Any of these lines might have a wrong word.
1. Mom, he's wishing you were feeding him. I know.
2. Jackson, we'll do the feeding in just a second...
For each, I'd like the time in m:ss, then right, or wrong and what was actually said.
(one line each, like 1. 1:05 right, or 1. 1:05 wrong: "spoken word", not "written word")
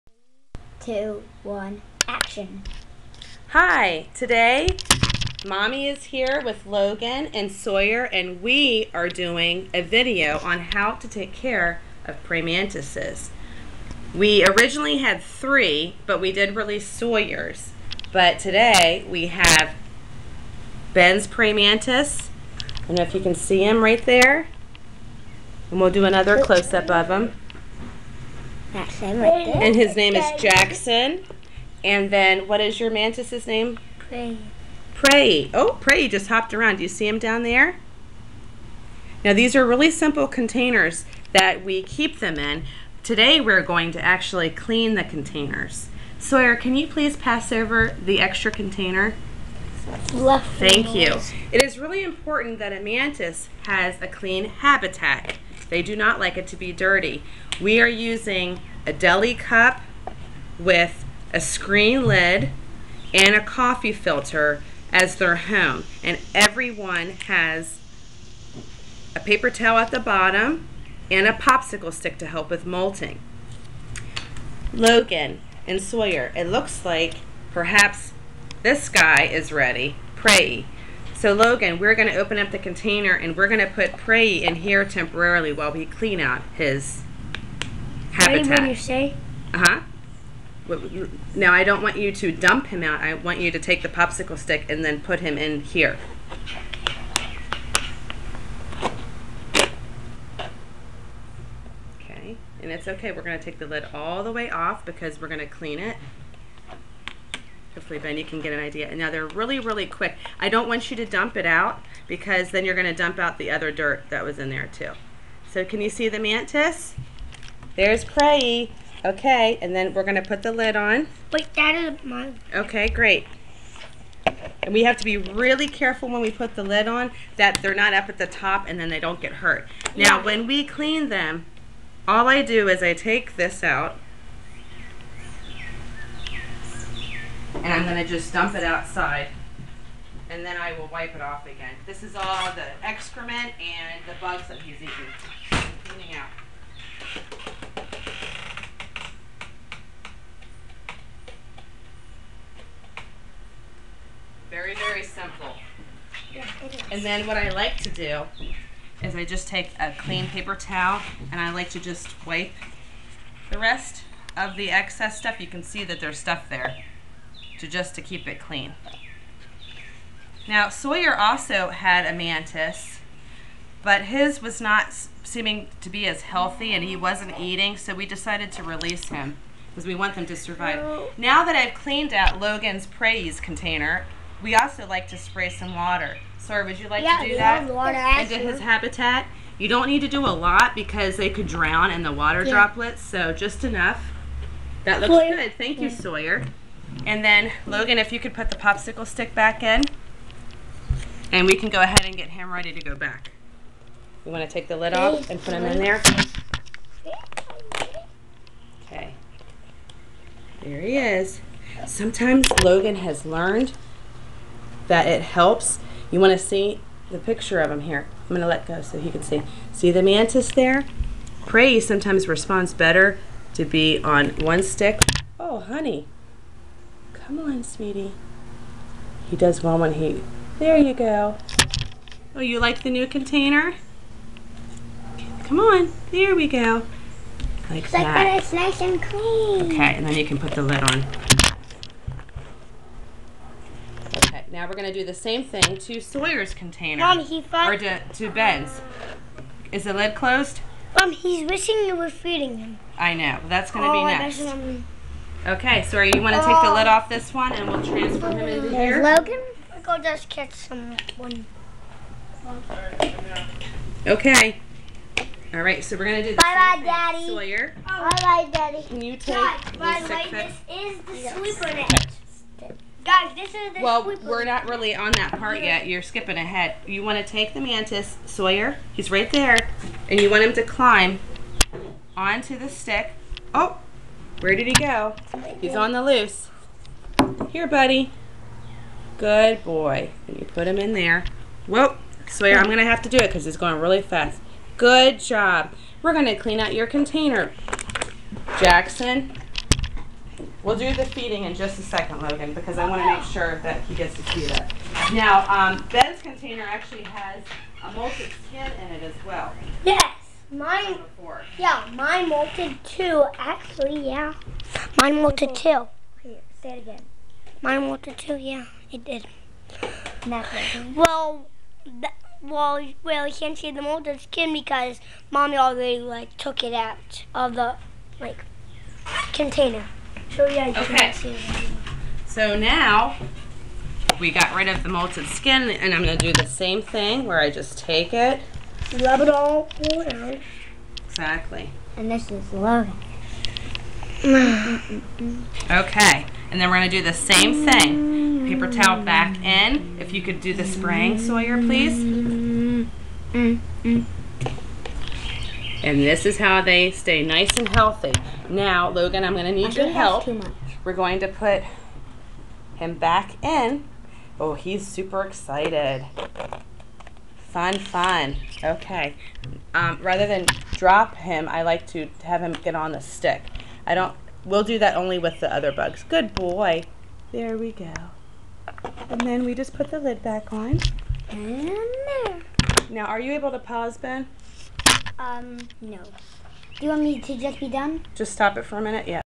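1. 4:10 right
2. 4:58 right.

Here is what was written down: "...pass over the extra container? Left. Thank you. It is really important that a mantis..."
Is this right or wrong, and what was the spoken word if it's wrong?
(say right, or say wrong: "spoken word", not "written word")
right.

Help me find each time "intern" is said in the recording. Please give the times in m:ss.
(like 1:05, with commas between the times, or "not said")
not said.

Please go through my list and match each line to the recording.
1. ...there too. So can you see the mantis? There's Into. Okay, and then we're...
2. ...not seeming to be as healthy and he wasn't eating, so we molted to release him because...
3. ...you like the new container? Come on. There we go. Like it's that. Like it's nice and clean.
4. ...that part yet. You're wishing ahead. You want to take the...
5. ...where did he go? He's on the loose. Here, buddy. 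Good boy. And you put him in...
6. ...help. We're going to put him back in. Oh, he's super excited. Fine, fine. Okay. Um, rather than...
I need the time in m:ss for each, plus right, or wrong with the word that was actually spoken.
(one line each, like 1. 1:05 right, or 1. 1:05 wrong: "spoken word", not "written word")
1. 1:54 wrong: "Prey", not "Into"
2. 2:54 wrong: "decided", not "molted"
3. 3:52 right
4. 4:35 wrong: "skipping", not "wishing"
5. 4:44 right
6. 5:59 right.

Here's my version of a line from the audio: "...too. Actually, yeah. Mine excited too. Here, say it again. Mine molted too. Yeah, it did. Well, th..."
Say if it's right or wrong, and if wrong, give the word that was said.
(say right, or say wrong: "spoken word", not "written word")
wrong: "molted", not "excited".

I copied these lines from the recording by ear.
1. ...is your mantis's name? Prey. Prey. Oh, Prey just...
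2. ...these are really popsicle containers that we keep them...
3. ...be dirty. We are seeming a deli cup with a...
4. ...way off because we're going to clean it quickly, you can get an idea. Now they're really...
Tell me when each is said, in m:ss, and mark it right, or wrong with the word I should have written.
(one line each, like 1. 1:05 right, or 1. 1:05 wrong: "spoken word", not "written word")
1. 0:32 right
2. 0:39 wrong: "simple", not "popsicle"
3. 0:56 wrong: "using", not "seeming"
4. 1:44 right.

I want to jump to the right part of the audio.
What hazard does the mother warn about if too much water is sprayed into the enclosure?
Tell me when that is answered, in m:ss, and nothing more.
3:11.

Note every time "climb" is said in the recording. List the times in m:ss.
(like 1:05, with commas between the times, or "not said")
4:40.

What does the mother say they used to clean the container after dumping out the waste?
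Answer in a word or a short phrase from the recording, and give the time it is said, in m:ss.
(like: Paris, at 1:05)
Clean paper towel, at 2:39.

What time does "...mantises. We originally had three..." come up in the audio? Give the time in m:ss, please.
0:12.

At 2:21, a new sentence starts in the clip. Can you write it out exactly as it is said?
This is all the excrement and the bugs that he's eating.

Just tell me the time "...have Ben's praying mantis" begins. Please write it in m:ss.
0:19.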